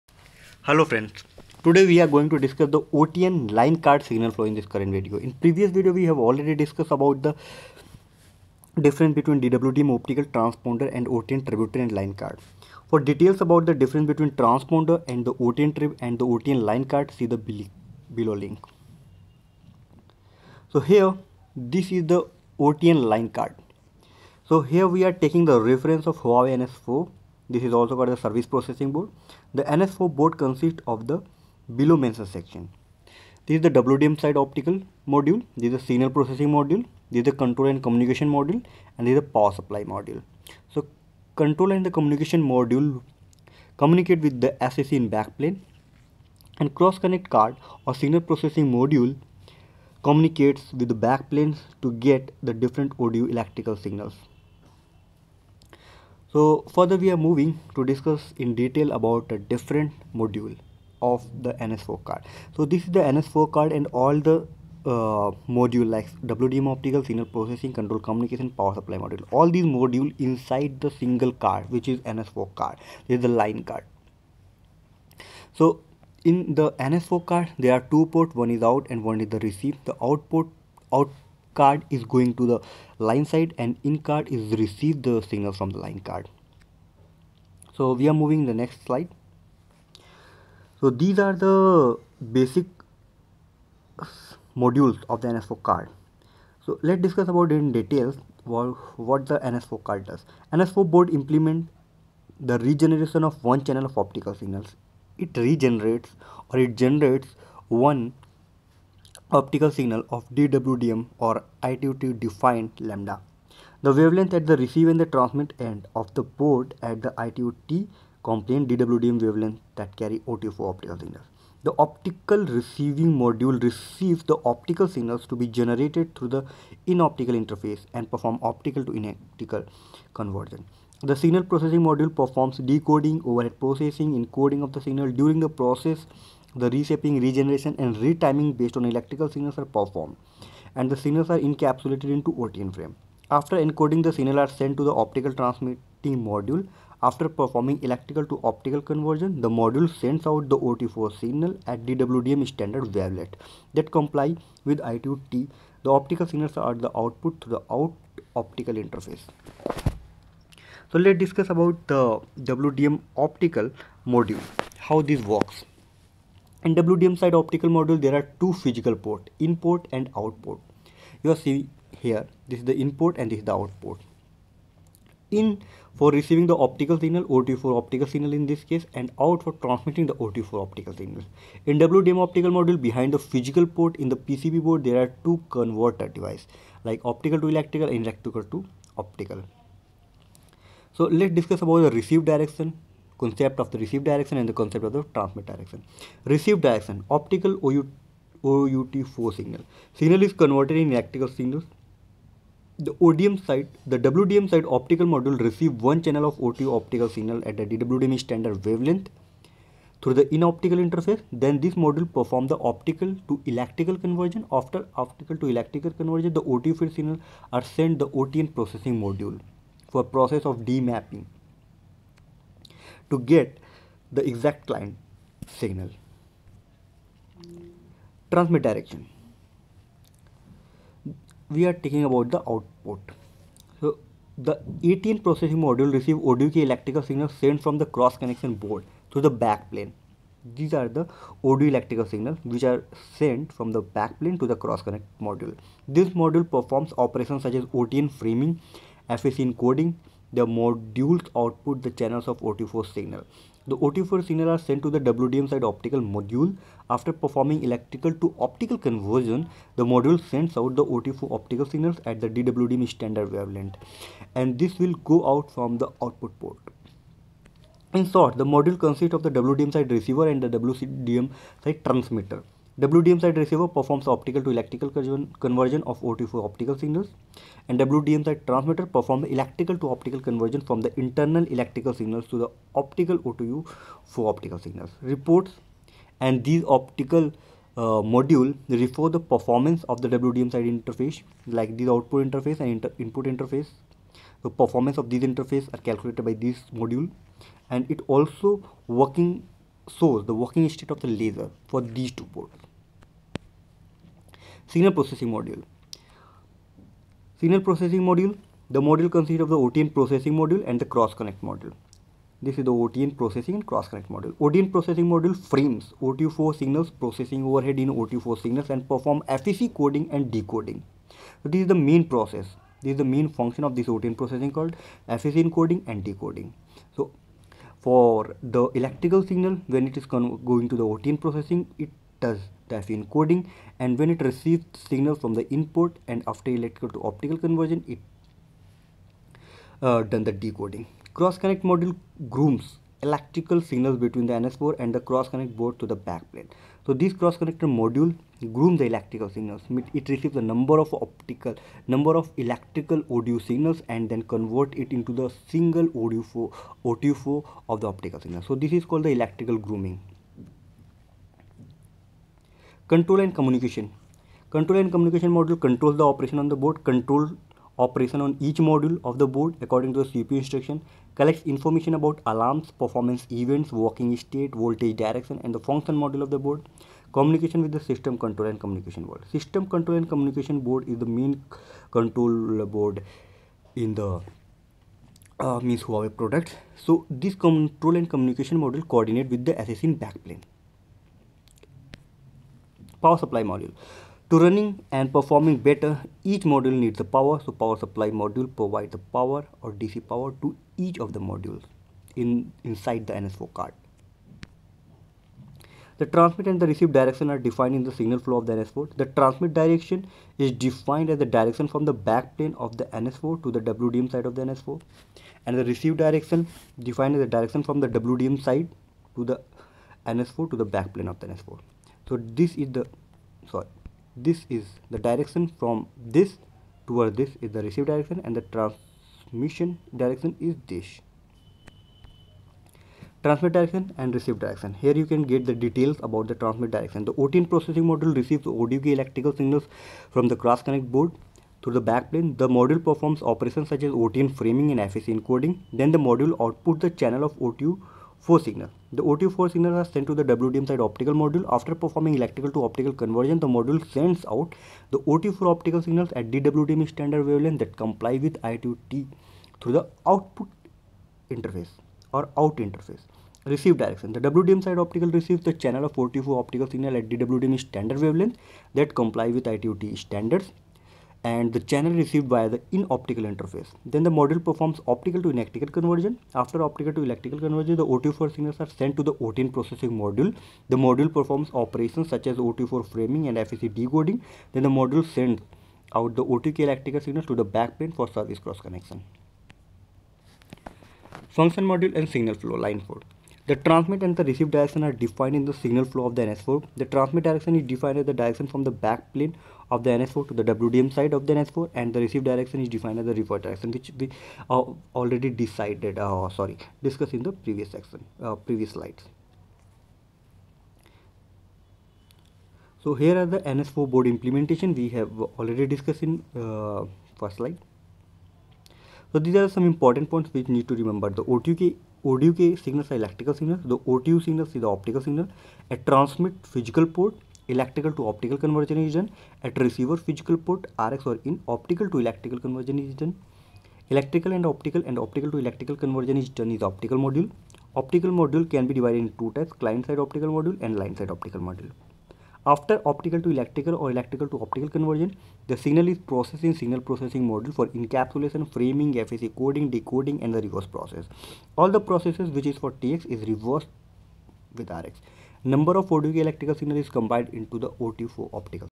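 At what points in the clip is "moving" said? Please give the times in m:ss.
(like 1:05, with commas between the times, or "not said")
0:57, 1:28.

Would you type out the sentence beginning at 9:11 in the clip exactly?
All the processes which is for TX is reversed with RX.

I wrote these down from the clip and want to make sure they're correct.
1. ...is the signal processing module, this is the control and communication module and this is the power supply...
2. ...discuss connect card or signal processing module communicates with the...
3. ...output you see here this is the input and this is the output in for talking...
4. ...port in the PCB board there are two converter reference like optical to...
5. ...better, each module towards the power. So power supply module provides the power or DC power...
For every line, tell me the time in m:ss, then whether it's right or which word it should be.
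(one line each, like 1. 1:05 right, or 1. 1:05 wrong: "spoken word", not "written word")
1. 0:35 right
2. 0:46 wrong: "cross", not "discuss"
3. 2:50 wrong: "receiving", not "talking"
4. 3:03 wrong: "device", not "reference"
5. 6:35 wrong: "needs", not "towards".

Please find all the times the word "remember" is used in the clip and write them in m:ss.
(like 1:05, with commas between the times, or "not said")
8:40.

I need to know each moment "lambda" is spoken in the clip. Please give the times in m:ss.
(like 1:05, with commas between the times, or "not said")
1:52.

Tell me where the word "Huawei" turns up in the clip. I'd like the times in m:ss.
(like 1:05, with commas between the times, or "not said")
0:26, 6:25.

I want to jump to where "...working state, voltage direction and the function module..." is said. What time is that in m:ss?
6:13.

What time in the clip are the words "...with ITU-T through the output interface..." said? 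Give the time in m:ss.
7:38.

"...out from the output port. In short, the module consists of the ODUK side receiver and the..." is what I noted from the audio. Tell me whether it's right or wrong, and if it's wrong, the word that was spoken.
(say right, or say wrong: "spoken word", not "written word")
wrong: "WDM", not "ODUK".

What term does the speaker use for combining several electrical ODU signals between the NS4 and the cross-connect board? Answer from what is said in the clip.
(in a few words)
electrical grooming.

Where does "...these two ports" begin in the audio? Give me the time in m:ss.
5:01.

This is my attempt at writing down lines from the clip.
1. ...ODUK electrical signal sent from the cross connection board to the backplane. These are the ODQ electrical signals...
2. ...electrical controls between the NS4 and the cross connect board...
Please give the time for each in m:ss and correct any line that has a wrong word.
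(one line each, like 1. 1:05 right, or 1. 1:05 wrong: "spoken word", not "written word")
1. 3:56 wrong: "ODU", not "ODQ"
2. 5:43 wrong: "signals", not "controls".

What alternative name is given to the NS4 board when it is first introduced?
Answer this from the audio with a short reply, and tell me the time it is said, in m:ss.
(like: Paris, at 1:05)
service processing board, at 0:28.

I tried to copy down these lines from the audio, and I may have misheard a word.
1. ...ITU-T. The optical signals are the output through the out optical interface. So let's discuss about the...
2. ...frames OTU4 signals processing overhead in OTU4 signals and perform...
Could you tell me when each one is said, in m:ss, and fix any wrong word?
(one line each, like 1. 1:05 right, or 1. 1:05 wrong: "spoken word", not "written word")
1. 2:34 right
2. 5:15 right.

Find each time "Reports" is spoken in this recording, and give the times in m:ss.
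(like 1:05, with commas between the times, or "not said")
4:45.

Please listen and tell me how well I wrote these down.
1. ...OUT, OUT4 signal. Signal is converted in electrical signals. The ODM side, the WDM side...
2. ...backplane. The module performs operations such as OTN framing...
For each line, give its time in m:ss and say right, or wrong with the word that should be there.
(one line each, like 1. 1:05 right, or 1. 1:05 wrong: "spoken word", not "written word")
1. 3:17 right
2. 7:21 right.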